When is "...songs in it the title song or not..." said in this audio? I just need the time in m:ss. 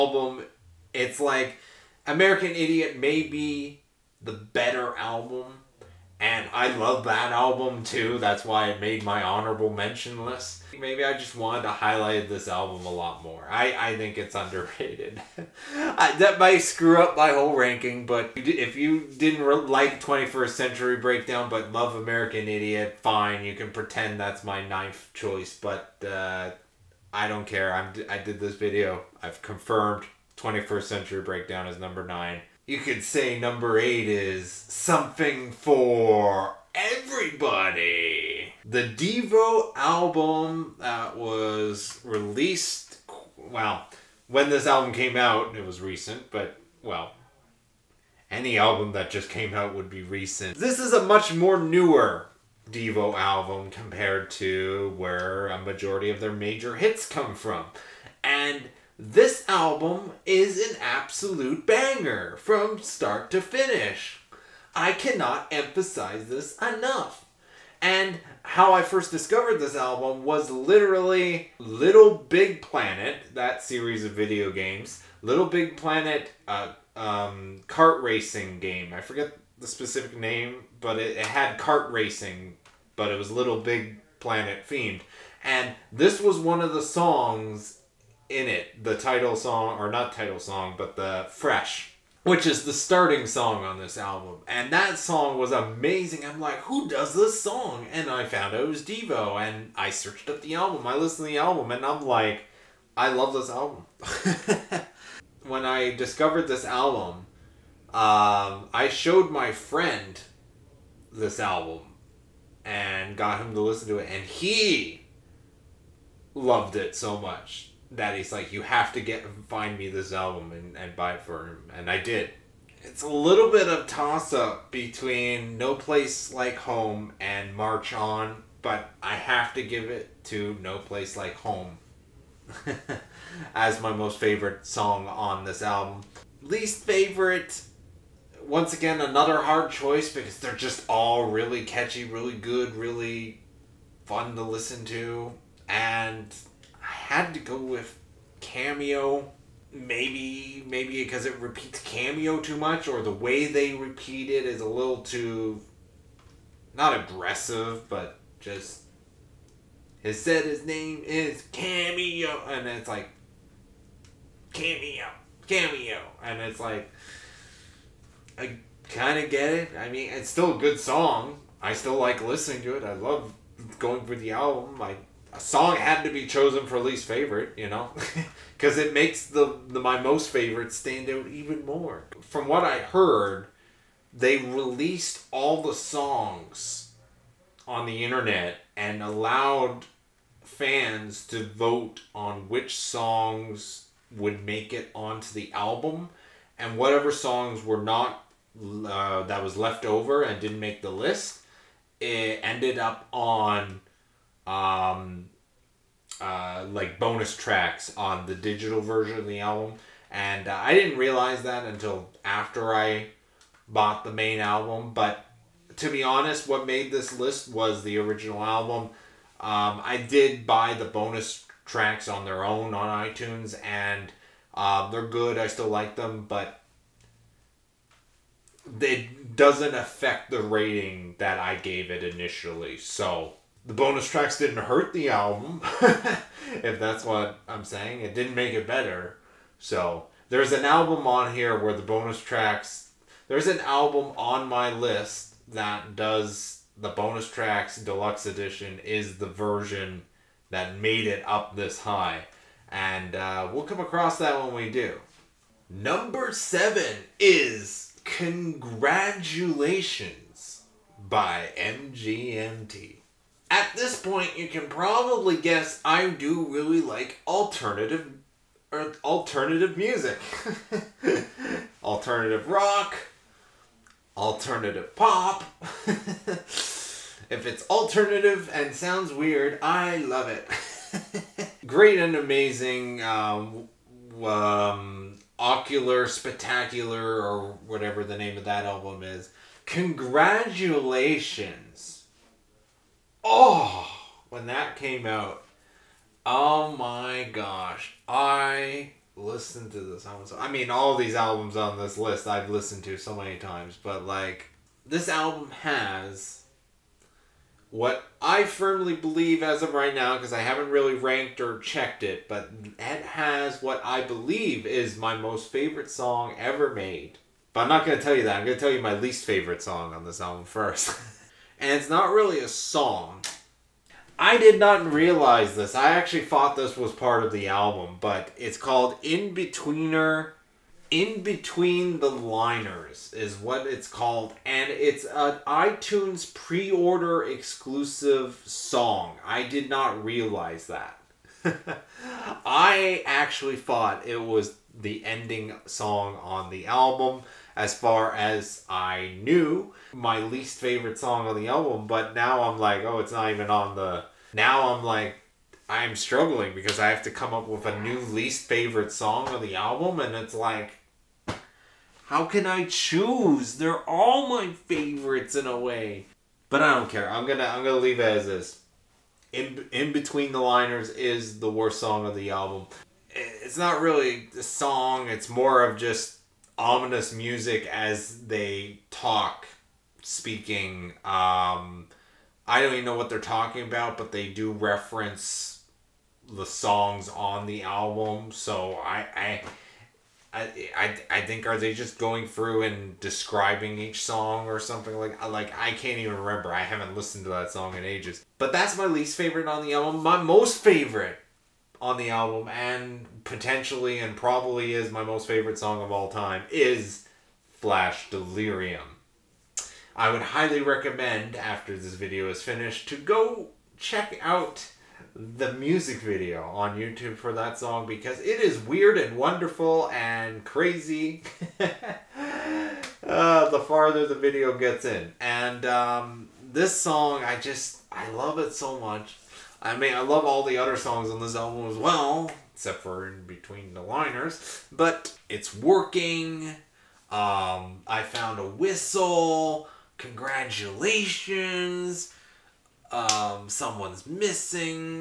1:26.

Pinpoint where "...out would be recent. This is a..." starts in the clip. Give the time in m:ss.
0:49.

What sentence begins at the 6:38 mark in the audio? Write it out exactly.
But that's my least favorite on the album.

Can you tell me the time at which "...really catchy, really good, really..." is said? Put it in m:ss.
2:21.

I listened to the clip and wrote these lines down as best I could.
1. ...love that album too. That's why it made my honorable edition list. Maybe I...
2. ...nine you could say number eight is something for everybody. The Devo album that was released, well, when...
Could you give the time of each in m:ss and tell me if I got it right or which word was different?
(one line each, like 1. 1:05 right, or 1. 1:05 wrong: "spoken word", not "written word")
1. 0:06 wrong: "mention", not "edition"
2. 0:32 right.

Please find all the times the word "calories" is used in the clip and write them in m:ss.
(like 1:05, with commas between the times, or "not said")
not said.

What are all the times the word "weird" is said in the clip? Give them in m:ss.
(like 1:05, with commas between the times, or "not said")
4:39, 6:58.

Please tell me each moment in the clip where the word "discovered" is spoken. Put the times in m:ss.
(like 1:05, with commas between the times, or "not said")
1:09, 1:45.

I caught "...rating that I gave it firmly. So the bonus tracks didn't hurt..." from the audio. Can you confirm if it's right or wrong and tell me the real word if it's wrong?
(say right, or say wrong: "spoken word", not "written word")
wrong: "initially", not "firmly".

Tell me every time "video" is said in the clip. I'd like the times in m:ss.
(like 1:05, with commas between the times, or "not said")
0:28, 1:14, 6:51, 6:56, 7:04.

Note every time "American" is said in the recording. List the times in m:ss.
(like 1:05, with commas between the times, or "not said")
0:02, 0:21.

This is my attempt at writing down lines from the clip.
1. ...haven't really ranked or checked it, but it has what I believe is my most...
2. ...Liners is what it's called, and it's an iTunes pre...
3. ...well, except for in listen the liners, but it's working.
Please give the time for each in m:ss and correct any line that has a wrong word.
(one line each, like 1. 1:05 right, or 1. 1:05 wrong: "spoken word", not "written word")
1. 5:10 right
2. 5:32 right
3. 7:11 wrong: "between", not "listen".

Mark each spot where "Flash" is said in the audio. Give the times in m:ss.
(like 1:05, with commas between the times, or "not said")
6:47.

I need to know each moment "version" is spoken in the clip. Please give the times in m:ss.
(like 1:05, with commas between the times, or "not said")
3:28, 4:09.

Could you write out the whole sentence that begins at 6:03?
They're all my favorites in a way.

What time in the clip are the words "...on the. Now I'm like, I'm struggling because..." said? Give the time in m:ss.
5:53.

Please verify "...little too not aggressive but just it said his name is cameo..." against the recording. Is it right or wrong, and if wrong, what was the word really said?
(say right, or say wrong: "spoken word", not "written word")
right.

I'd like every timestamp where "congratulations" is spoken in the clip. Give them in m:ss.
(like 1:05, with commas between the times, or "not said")
4:18, 4:49, 7:19.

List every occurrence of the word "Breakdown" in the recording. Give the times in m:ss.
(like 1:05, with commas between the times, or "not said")
0:20, 0:31.